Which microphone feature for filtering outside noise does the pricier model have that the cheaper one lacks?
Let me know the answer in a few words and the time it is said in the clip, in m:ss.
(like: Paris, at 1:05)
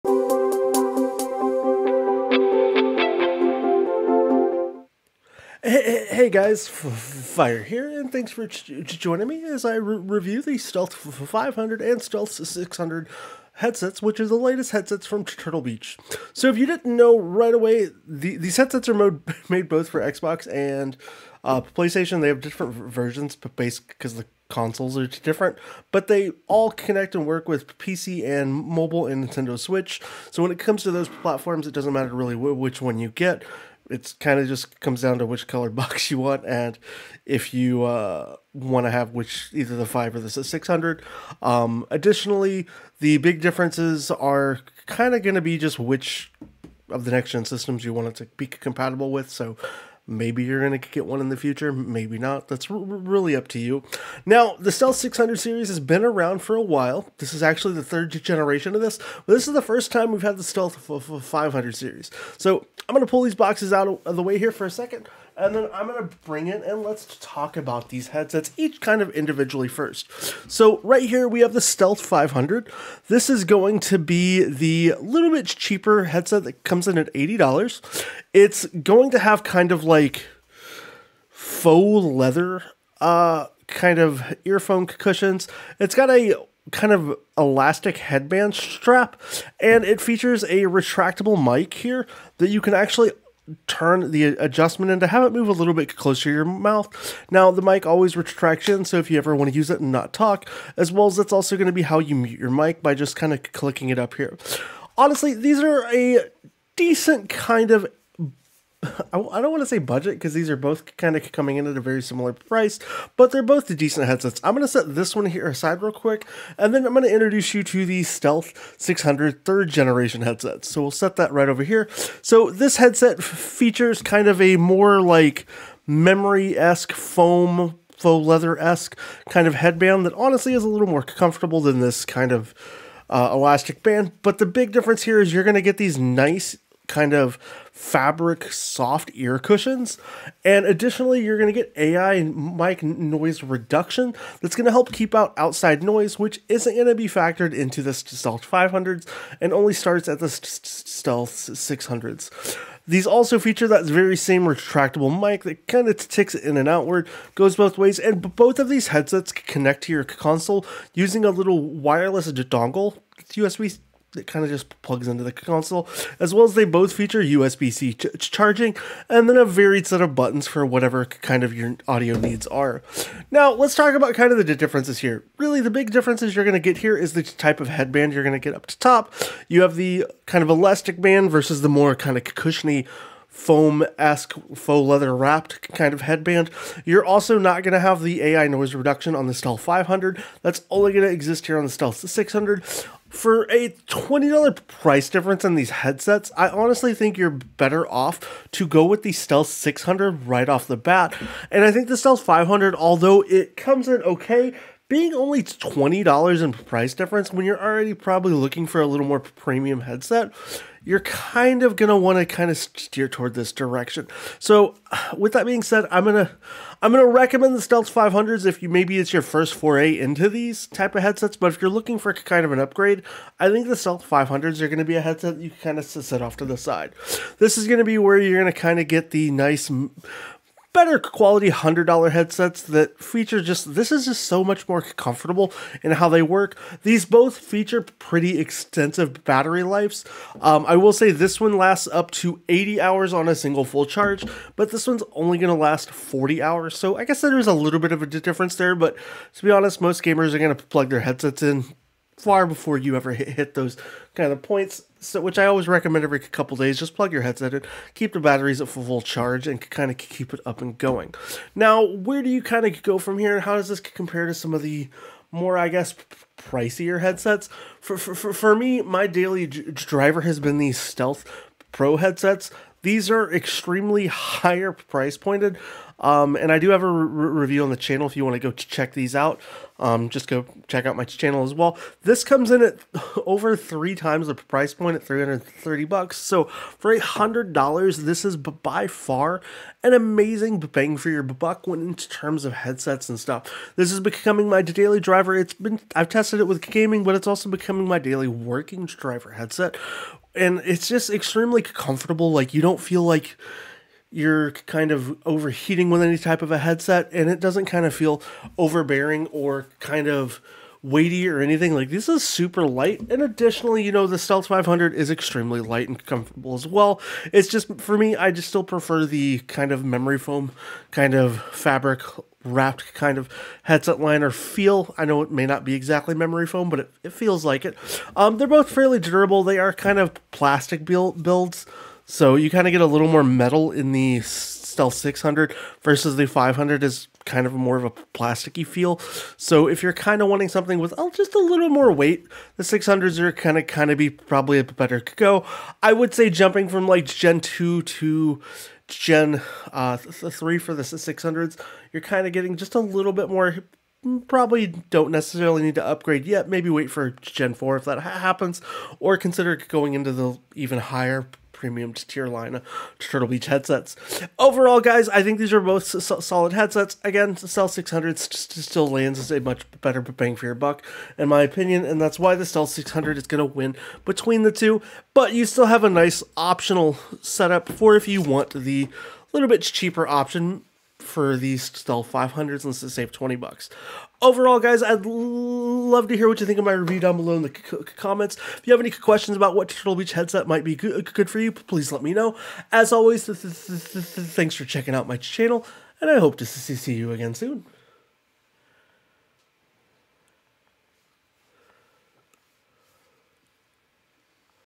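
AI mic noise reduction, at 2:21.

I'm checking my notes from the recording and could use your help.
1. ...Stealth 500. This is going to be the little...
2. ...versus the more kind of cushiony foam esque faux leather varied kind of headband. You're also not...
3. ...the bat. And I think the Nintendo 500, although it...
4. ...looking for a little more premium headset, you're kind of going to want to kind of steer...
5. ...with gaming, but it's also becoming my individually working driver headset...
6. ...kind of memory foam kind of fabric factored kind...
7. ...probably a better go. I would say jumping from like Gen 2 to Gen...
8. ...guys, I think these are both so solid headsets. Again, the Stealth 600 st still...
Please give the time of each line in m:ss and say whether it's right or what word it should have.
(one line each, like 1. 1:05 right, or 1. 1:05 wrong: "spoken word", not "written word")
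1. 1:11 right
2. 3:01 wrong: "wrapped", not "varied"
3. 3:20 wrong: "Stealth", not "Nintendo"
4. 3:28 right
5. 4:56 wrong: "daily", not "individually"
6. 5:19 wrong: "wrapped", not "factored"
7. 5:44 right
8. 6:04 right.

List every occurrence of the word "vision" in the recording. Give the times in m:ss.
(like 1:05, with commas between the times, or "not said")
not said.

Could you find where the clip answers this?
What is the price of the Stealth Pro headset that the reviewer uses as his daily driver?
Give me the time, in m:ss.
4:45.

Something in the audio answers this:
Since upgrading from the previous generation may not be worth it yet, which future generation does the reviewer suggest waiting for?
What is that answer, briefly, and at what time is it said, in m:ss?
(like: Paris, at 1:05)
Gen 4, at 5:57.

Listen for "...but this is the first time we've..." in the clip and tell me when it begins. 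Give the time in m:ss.
0:59.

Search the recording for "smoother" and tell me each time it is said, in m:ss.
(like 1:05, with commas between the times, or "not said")
not said.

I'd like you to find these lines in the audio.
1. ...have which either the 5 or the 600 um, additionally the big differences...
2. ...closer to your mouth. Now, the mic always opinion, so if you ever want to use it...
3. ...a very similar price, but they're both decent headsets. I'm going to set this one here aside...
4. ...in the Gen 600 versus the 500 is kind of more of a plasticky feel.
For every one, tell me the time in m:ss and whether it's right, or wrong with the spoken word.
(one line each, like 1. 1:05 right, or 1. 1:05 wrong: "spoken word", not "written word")
1. 0:38 right
2. 1:35 wrong: "retraction", not "opinion"
3. 1:51 right
4. 5:33 wrong: "Stealth", not "Gen".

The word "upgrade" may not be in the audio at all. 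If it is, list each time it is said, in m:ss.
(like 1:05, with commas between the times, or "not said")
3:42, 5:55.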